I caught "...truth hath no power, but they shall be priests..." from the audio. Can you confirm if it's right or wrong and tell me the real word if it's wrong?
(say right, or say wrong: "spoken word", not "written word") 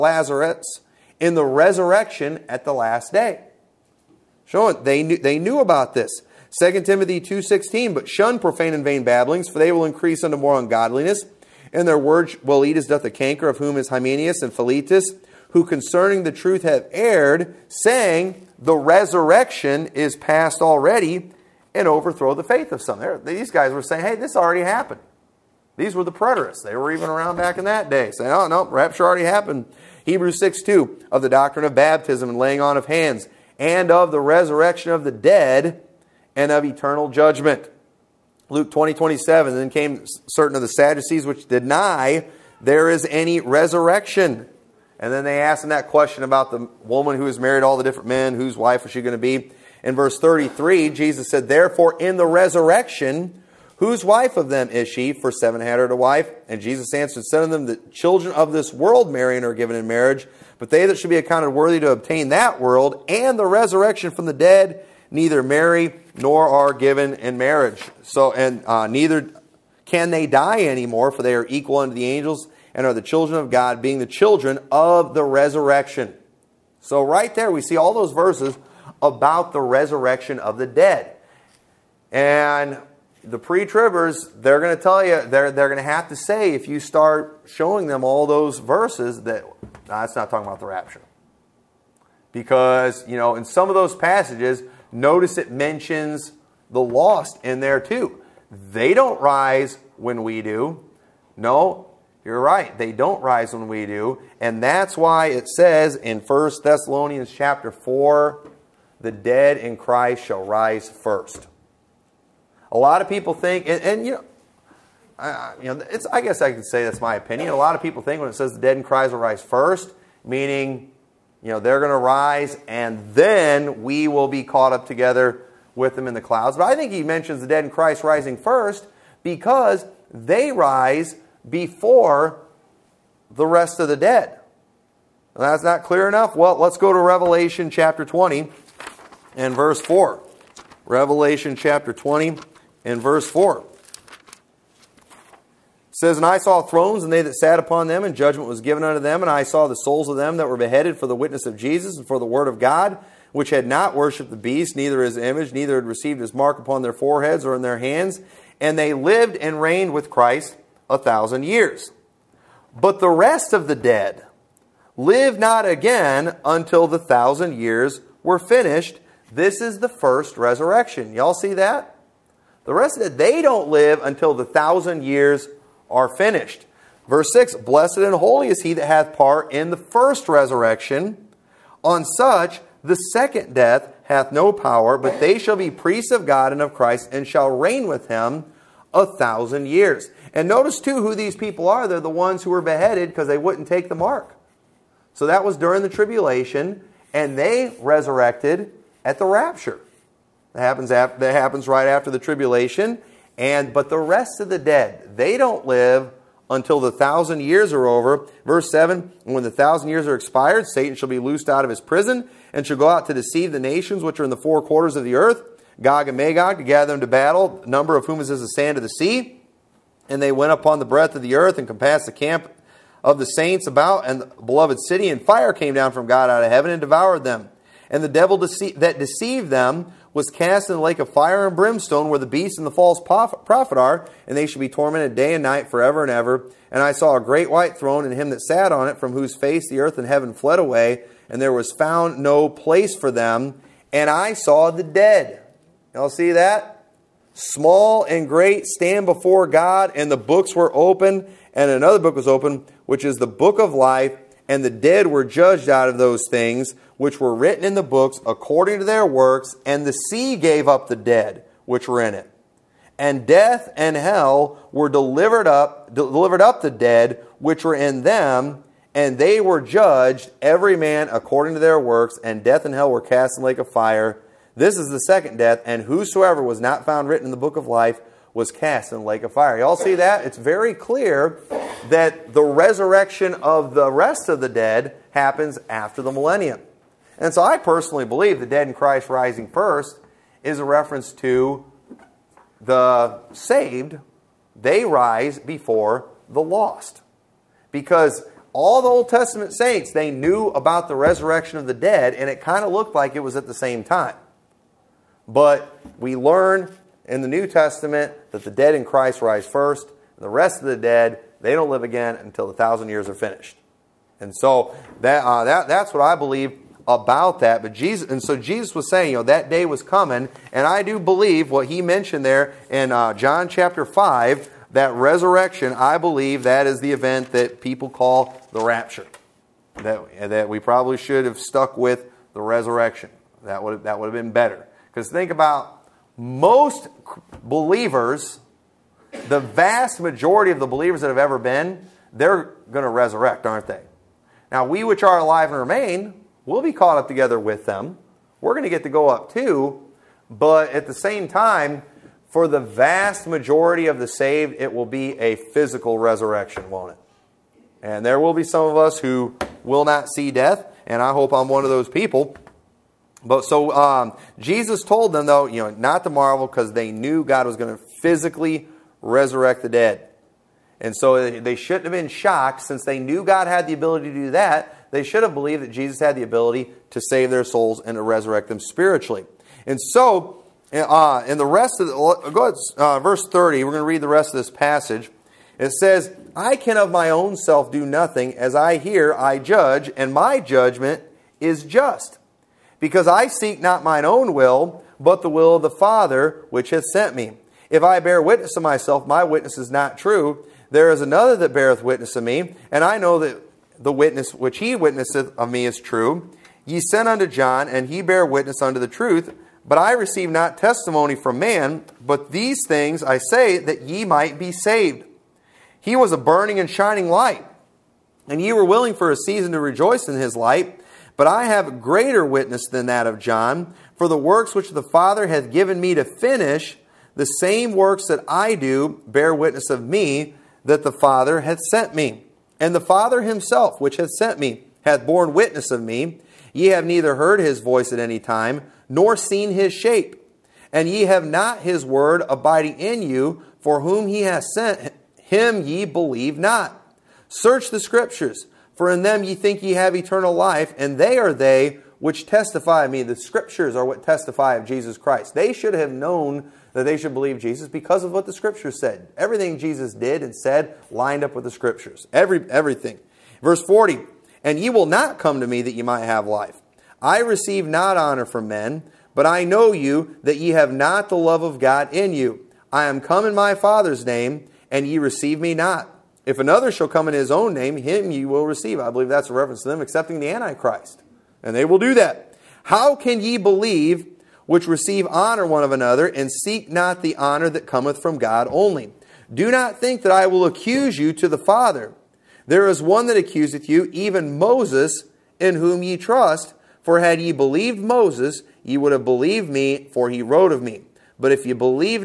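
wrong: "death", not "truth".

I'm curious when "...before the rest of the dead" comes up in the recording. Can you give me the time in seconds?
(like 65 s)
131 s.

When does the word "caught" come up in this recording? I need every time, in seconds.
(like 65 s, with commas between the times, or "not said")
124 s, 346 s.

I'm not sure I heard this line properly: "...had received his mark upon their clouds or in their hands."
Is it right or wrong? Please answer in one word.
wrong.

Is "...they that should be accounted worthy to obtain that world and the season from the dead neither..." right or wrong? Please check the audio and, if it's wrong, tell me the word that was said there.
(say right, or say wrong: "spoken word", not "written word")
wrong: "resurrection", not "season".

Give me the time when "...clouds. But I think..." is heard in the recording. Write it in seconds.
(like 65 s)
126 s.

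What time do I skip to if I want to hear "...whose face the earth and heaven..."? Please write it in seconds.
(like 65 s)
239 s.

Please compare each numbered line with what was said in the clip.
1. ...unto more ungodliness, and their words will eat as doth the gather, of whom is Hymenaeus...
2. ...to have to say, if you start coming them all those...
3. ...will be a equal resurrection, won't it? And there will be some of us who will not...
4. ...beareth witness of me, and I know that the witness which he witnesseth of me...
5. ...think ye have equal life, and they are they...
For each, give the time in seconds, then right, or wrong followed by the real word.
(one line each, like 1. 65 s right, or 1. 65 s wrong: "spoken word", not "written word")
1. 10 s wrong: "canker", not "gather"
2. 85 s wrong: "showing", not "coming"
3. 354 s wrong: "physical", not "equal"
4. 401 s right
5. 449 s wrong: "eternal", not "equal".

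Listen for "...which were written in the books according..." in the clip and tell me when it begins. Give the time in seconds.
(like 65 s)
256 s.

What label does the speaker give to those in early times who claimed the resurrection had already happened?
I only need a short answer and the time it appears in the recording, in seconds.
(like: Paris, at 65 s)
Preterists, at 26 s.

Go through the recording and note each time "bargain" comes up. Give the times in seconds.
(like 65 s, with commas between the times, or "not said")
not said.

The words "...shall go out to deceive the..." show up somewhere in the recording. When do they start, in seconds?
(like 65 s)
212 s.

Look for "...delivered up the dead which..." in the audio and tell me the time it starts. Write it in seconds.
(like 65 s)
265 s.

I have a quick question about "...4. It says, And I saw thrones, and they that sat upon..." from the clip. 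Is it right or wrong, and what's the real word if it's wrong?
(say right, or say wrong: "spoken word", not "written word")
right.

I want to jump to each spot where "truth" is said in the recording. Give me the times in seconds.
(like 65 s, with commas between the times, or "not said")
16 s, 408 s.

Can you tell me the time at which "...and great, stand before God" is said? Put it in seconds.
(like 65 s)
248 s.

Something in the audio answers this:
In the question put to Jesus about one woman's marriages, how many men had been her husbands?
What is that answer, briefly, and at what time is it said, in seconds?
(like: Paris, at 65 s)
7, at 55 s.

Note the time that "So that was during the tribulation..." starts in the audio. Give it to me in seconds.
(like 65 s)
195 s.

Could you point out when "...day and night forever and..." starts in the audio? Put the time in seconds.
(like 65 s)
235 s.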